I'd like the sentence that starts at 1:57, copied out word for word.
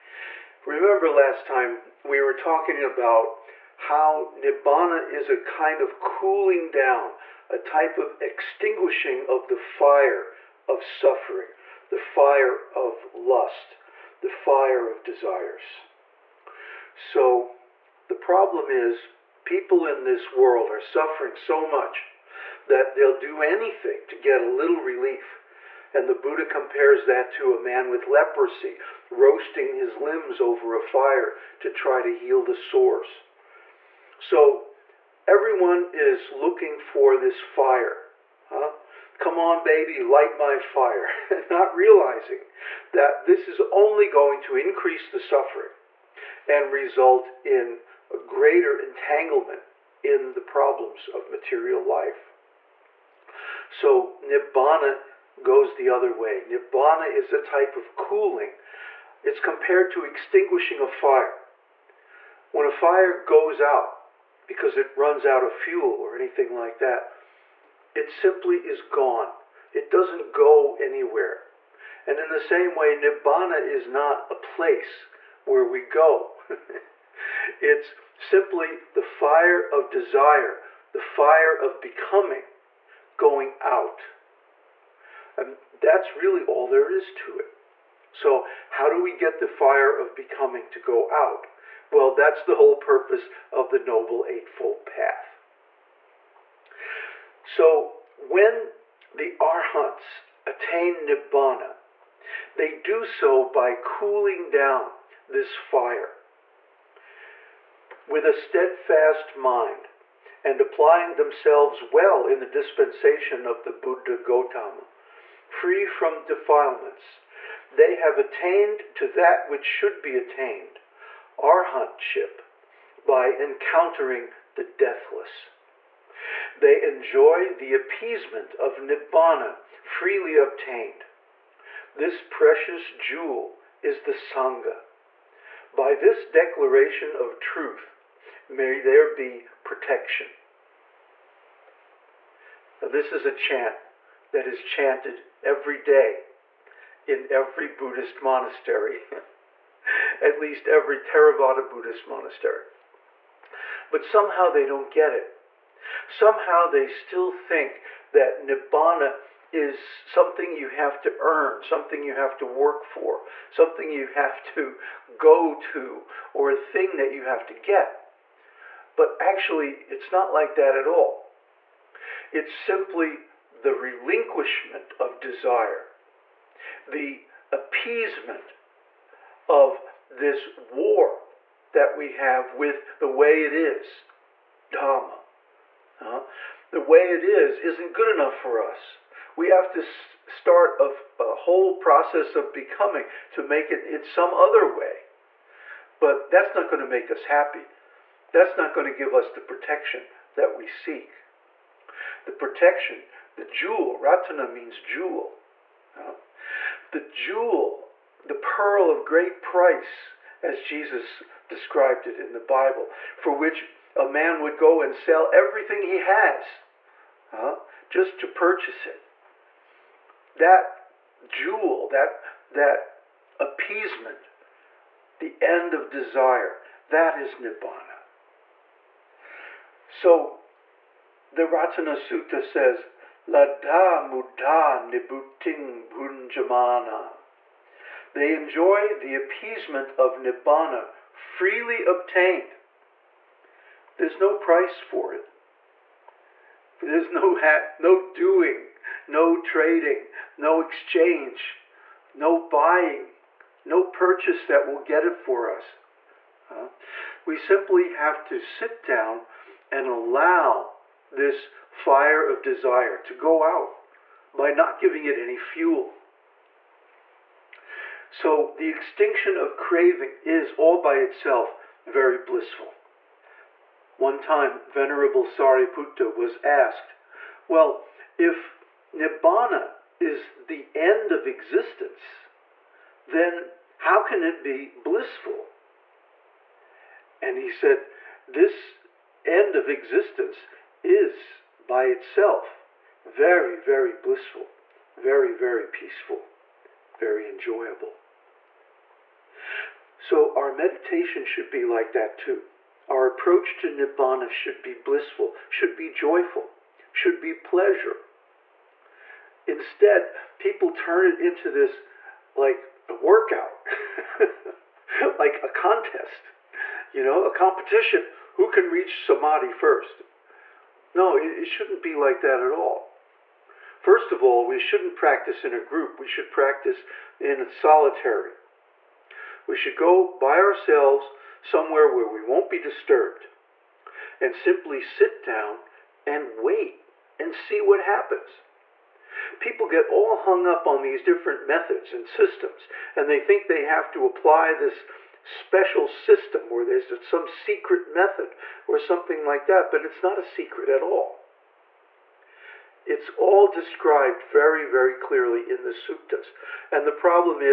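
They have attained to that which should be attained, arahantship by encountering the deathless.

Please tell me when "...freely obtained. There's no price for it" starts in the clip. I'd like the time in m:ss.
4:01.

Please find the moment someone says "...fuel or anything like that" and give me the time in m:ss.
1:05.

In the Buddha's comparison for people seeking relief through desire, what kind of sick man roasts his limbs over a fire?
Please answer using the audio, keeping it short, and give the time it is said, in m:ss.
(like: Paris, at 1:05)
A man with leprosy, at 0:27.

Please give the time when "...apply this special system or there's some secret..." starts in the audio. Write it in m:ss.
5:44.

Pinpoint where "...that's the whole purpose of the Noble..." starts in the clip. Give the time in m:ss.
1:32.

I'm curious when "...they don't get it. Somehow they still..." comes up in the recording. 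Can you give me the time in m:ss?
2:34.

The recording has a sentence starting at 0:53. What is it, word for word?
So Nibbana goes the other way.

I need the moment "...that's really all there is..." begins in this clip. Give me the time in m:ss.
1:25.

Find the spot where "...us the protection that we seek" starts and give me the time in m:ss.
3:19.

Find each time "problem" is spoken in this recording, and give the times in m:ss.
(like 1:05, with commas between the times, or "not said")
0:18, 0:50.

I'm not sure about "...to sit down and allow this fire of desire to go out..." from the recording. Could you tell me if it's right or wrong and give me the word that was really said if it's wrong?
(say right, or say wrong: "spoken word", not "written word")
right.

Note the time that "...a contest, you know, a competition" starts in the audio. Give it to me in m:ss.
5:15.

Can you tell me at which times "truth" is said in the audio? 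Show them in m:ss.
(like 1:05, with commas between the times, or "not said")
2:17.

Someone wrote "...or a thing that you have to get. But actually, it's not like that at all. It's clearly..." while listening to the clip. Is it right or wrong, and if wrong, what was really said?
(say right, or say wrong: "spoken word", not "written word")
wrong: "simply", not "clearly".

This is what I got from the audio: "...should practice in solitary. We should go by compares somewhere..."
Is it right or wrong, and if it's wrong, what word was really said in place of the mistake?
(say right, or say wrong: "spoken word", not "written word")
wrong: "ourselves", not "compares".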